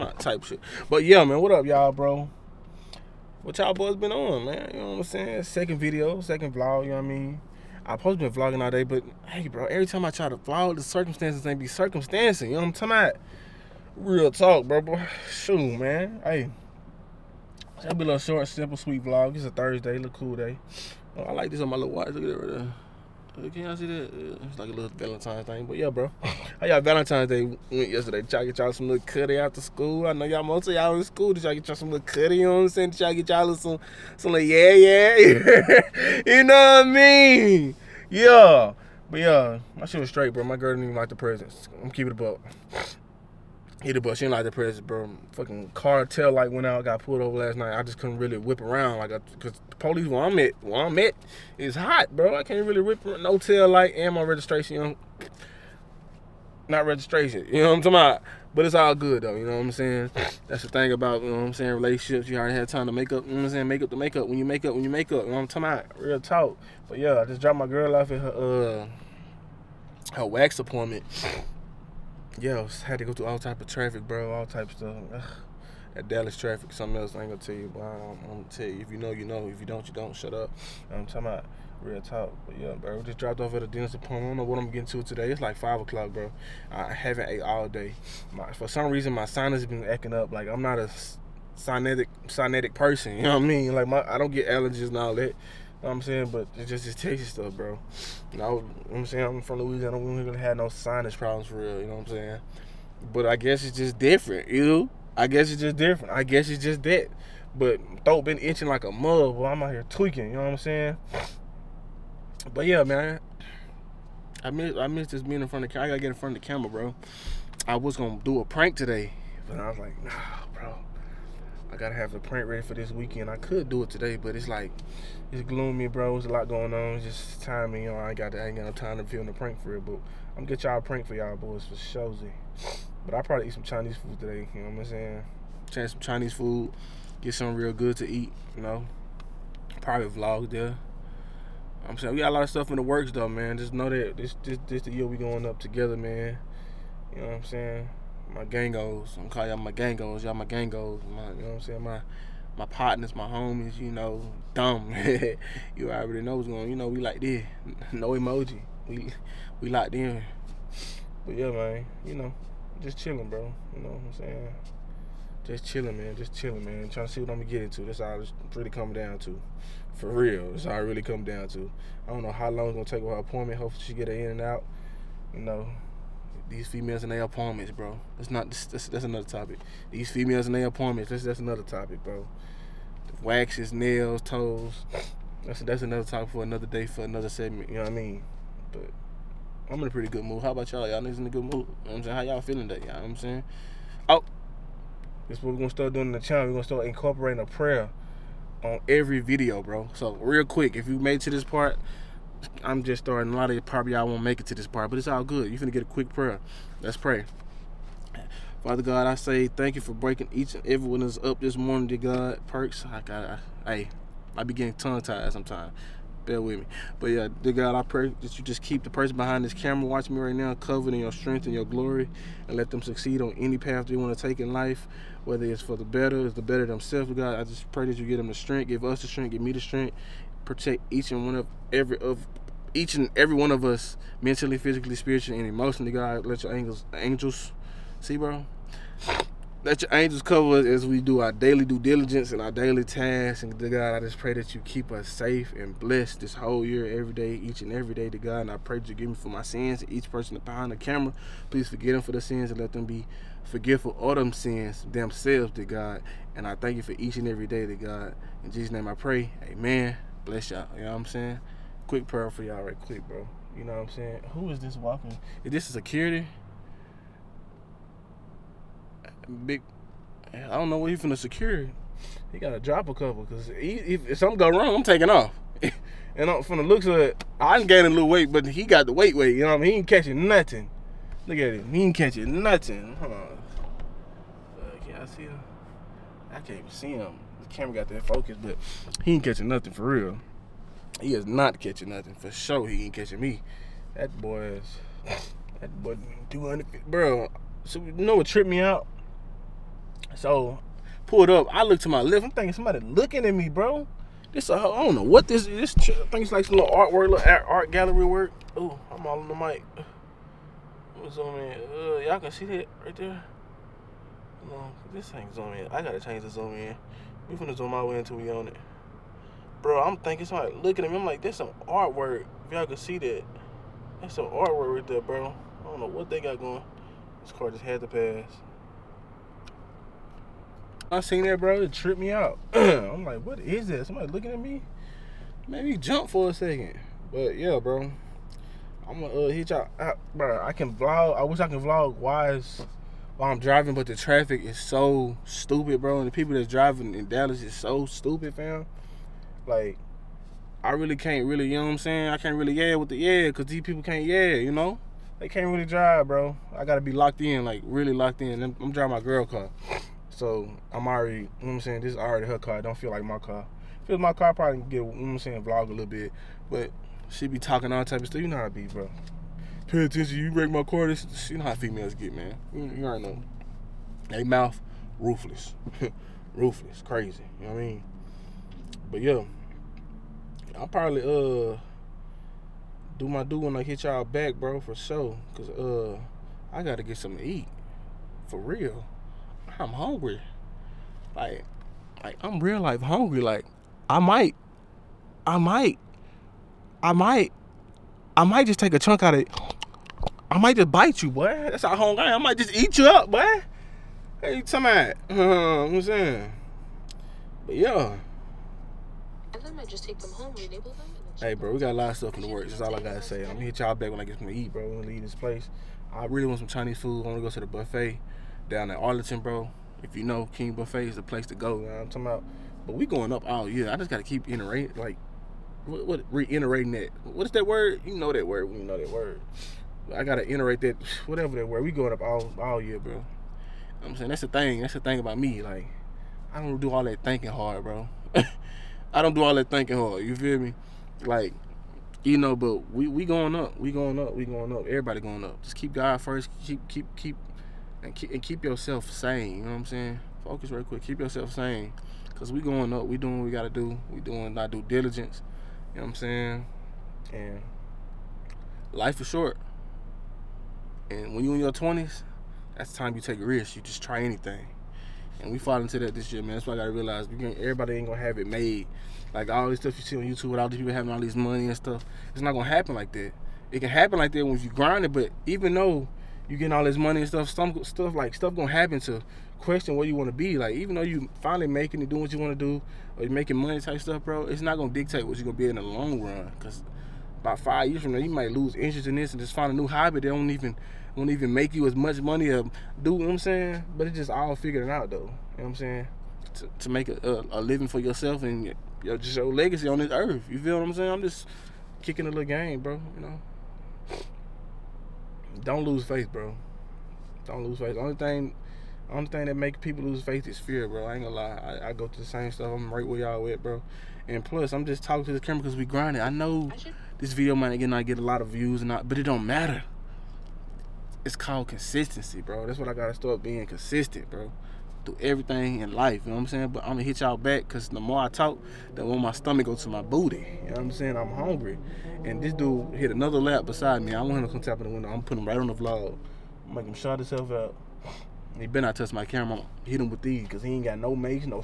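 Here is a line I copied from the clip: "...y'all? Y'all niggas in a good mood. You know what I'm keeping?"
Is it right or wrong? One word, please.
wrong.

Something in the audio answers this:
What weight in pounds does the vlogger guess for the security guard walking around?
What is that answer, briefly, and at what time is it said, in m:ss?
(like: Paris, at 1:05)
200, at 4:56.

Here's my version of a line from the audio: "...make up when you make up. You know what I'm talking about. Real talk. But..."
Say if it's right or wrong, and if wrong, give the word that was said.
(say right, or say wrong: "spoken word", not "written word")
right.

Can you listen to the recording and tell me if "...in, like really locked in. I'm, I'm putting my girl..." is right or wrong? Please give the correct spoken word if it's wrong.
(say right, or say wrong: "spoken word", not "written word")
wrong: "driving", not "putting".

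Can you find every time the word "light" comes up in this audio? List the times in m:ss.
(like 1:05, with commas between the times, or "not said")
0:46, 0:53.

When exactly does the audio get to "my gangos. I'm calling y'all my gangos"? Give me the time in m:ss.
2:28.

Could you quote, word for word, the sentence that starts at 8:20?
I'm just kicking a little game, bro.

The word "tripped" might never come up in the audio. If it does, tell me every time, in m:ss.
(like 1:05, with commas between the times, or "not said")
4:58, 5:31.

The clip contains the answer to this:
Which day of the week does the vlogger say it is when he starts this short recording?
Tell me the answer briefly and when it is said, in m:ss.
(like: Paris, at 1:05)
Thursday, at 0:19.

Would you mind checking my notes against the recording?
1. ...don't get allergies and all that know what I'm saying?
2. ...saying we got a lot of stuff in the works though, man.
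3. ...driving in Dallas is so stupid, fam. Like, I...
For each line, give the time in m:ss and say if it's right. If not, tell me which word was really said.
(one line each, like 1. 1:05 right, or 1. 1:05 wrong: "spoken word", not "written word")
1. 1:34 right
2. 2:21 right
3. 5:46 right.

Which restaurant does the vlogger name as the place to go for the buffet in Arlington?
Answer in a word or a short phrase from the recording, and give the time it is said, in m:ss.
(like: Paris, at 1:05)
King Buffet, at 7:00.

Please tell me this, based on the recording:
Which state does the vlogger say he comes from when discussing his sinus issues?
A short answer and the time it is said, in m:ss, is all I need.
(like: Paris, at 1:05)
Louisiana, at 1:39.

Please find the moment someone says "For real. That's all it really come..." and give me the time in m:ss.
2:49.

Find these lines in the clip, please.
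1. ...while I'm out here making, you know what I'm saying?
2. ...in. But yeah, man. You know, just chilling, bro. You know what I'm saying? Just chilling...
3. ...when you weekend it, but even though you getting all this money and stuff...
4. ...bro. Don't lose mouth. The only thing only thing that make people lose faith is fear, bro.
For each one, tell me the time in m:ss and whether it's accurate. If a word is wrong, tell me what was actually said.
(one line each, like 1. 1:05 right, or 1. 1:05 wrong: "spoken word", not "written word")
1. 1:49 wrong: "tweaking", not "making"
2. 2:39 right
3. 7:54 wrong: "grind", not "weekend"
4. 8:26 wrong: "faith", not "mouth".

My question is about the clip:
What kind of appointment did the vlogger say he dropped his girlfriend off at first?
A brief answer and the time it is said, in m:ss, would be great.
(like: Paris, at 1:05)
wax appointment, at 1:10.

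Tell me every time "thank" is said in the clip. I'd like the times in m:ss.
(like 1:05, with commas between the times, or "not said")
3:29, 4:16.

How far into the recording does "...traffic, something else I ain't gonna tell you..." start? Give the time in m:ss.
1:16.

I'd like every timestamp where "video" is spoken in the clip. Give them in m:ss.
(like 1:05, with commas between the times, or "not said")
0:05, 3:19, 8:37.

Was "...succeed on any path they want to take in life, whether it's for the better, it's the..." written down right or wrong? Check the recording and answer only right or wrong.
right.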